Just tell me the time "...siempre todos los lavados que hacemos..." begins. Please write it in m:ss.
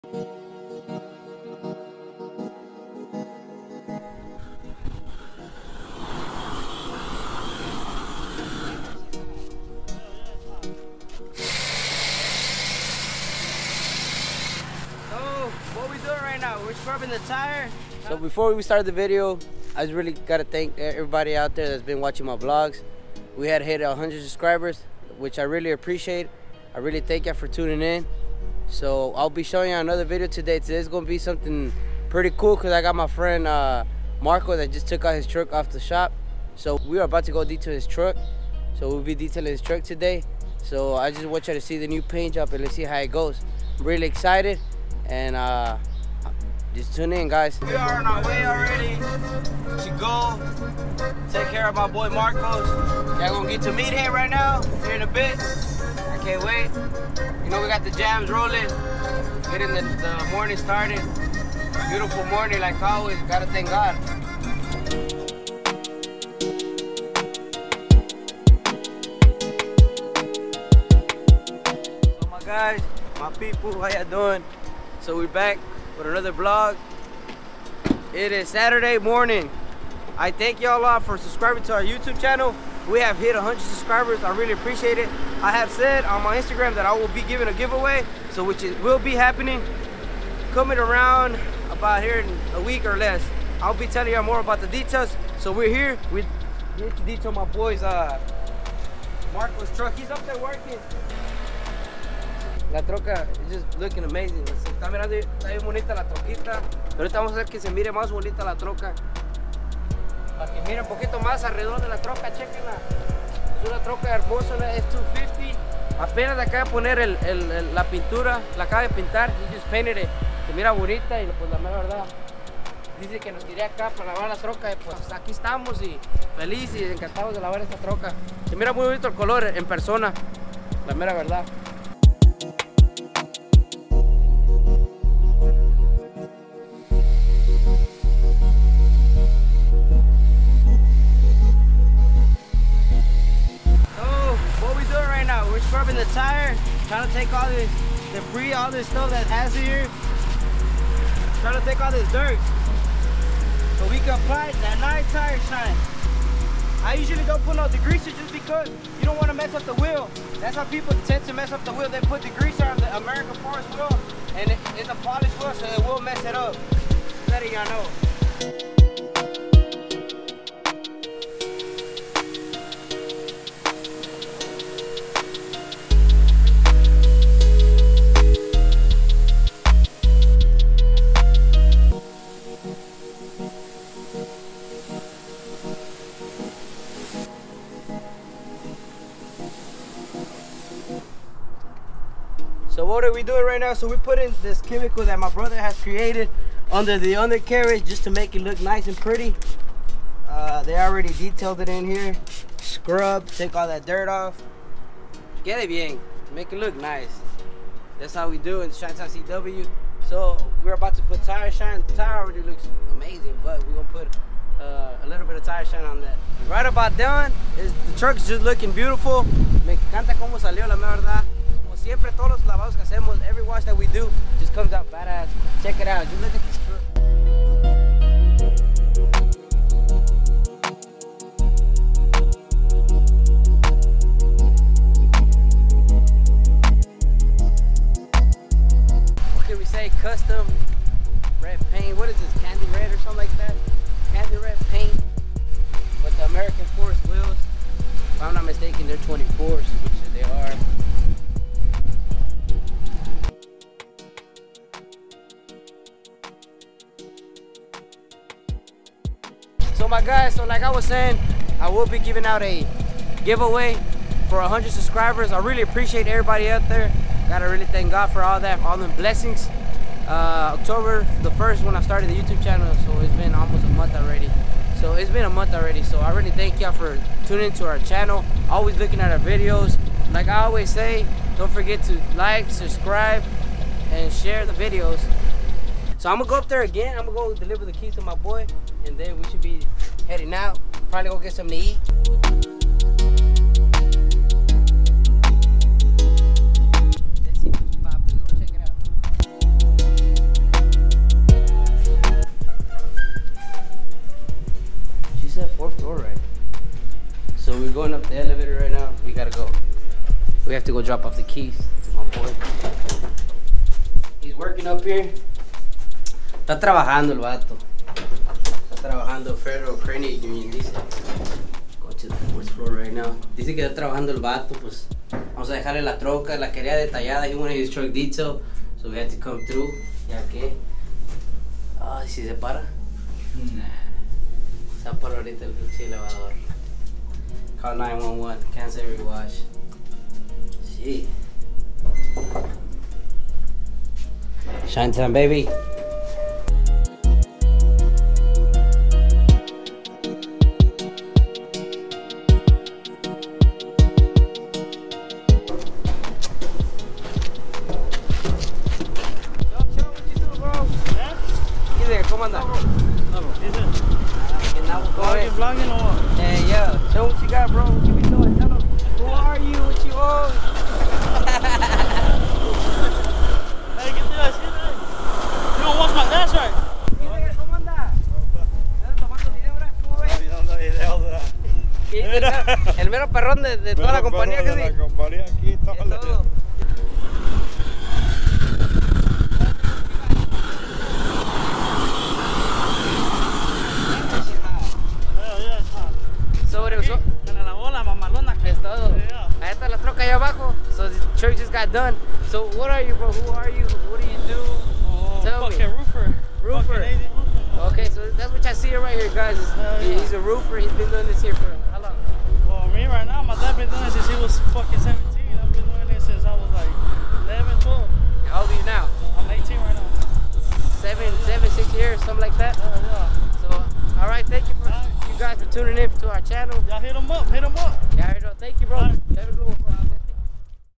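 3:41.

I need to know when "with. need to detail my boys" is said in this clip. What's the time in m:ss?
1:36.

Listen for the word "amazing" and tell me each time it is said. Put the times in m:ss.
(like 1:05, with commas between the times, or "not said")
1:44, 3:32.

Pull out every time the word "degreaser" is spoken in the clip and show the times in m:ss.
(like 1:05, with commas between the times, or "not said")
2:37, 2:42.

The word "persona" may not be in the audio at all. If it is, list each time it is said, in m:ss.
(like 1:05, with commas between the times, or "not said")
2:09.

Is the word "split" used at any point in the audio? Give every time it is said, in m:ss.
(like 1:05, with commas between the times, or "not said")
not said.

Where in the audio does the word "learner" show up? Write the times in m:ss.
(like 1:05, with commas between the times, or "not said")
not said.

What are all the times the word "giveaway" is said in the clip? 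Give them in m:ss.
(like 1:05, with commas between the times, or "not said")
1:27, 4:23.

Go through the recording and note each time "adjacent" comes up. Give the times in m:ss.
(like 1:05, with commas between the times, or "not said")
not said.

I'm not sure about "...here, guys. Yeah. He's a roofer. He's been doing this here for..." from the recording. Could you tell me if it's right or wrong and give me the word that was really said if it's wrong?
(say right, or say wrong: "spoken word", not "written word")
right.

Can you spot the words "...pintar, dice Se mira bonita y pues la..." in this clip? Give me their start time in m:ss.
1:58.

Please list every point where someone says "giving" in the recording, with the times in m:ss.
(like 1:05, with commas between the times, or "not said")
1:27, 4:21.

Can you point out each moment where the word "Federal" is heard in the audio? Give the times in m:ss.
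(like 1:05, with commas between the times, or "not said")
5:19.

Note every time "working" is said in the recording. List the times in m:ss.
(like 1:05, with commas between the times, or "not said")
1:40, 5:14.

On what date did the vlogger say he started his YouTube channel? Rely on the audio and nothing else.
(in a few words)
October 1.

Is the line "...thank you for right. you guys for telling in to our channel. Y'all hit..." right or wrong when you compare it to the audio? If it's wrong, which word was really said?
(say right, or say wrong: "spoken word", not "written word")
wrong: "tuning", not "telling".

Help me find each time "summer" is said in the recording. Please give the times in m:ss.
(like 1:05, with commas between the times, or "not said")
not said.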